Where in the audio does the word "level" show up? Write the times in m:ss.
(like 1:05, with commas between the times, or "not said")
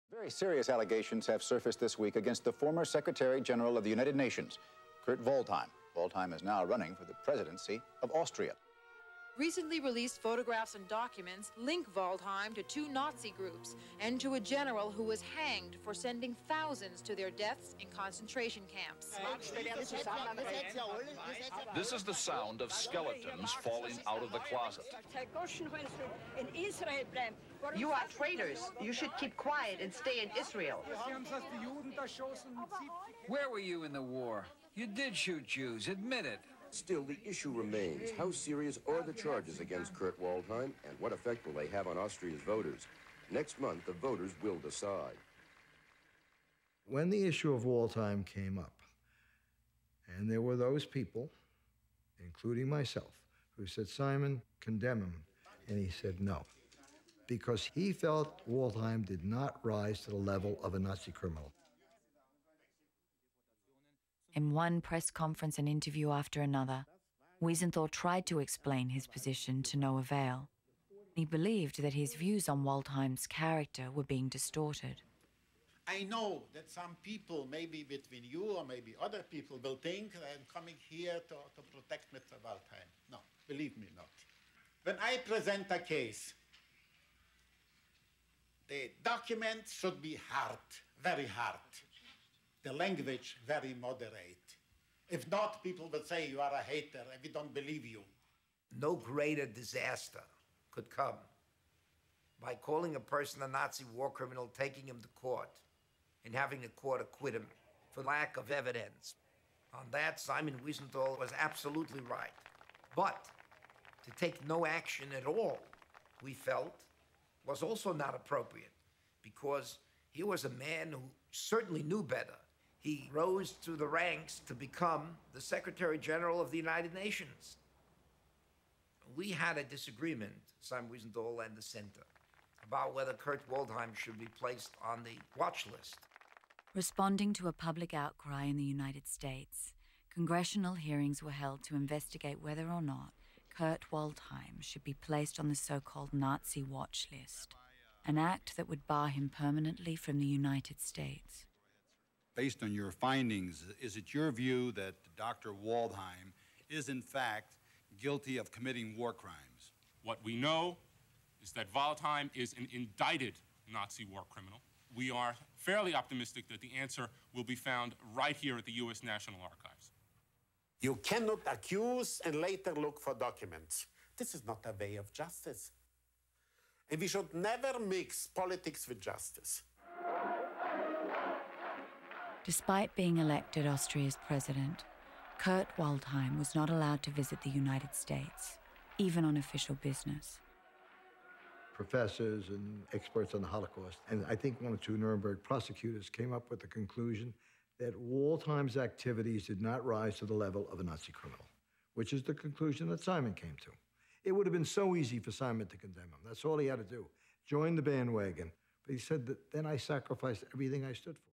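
1:00, 3:20.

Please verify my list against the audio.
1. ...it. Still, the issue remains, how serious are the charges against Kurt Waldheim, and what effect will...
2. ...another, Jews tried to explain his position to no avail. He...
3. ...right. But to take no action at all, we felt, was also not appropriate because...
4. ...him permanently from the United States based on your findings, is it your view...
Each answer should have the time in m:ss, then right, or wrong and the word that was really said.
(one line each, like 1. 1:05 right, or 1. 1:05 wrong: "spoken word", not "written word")
1. 0:36 right
2. 1:06 wrong: "Wiesenthal", not "Jews"
3. 1:52 right
4. 2:29 right.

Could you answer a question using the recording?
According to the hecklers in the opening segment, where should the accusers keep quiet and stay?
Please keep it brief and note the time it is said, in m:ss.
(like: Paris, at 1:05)
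Israel, at 0:30.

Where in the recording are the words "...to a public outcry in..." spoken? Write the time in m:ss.
2:17.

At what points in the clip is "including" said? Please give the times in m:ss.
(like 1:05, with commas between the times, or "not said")
0:52.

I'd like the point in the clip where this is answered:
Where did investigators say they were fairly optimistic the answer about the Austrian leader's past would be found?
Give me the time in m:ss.
2:48.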